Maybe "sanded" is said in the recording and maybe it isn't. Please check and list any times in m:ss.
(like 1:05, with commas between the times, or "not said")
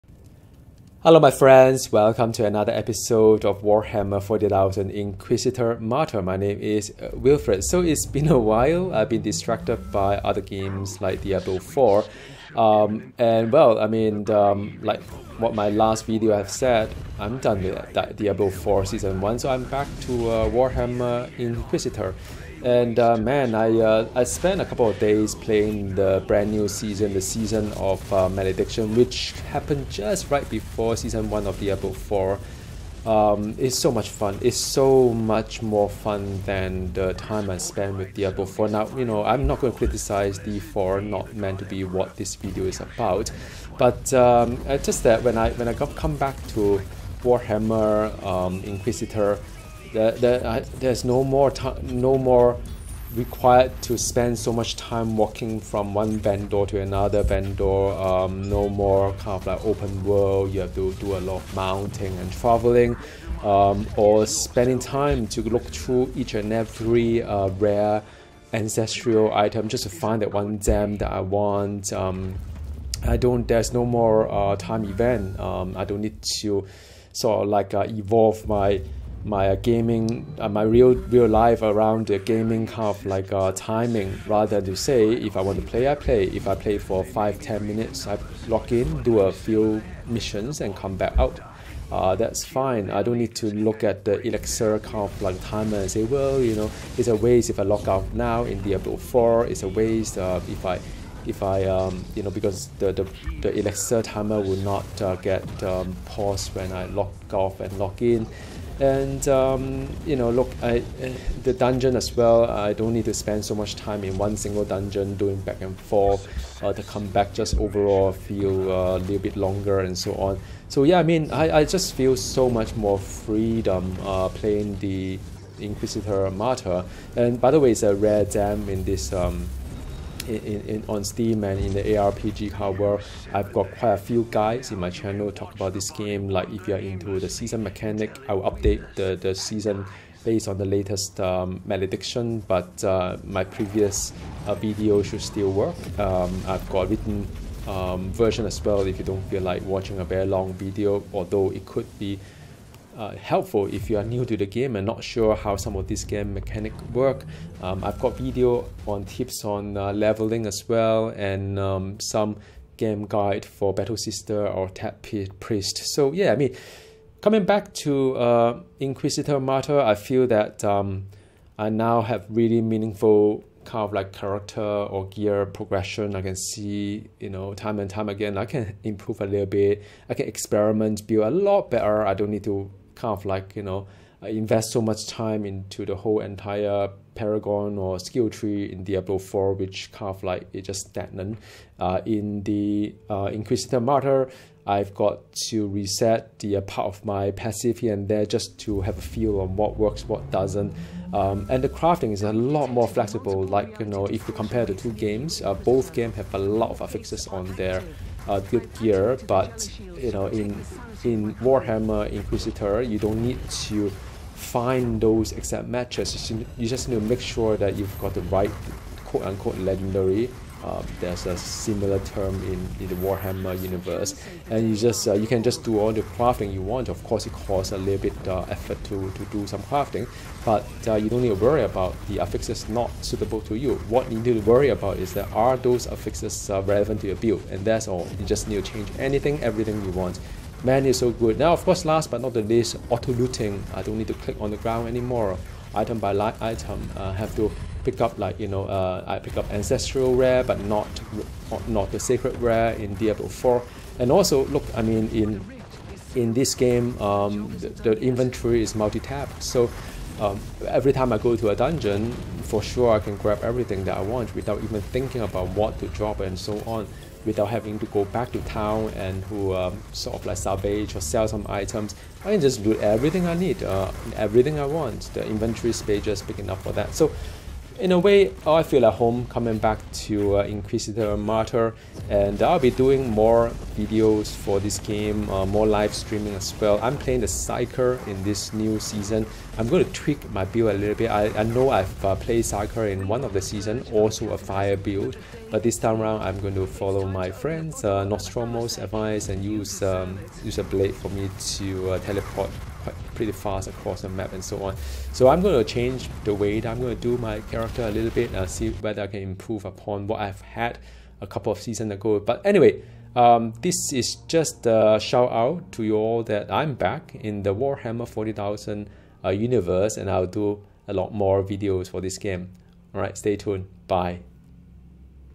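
not said.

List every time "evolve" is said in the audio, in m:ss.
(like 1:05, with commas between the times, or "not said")
1:17.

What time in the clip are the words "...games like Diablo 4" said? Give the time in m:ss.
0:10.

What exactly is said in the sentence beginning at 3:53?
What you need to worry about is that are those affixes uh, relevant to your build, and that's all.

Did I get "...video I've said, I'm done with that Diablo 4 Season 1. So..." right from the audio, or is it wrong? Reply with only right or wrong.
right.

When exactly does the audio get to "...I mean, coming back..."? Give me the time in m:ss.
2:46.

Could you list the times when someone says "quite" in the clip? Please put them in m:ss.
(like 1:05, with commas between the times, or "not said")
2:13, 5:02.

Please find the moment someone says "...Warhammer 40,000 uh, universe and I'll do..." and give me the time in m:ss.
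5:17.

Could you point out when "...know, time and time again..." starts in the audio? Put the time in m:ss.
2:57.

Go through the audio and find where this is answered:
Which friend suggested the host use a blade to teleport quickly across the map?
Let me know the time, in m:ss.
4:58.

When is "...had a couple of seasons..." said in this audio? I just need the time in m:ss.
5:10.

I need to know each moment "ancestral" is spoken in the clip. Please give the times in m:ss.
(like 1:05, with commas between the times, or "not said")
1:08, 4:09.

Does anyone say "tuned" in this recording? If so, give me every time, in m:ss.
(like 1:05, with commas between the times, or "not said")
5:23.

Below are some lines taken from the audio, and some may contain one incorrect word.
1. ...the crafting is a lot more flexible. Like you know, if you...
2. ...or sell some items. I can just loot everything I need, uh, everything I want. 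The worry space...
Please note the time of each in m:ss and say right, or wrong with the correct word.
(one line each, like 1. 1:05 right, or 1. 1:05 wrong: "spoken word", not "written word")
1. 3:21 right
2. 4:30 wrong: "inventory", not "worry".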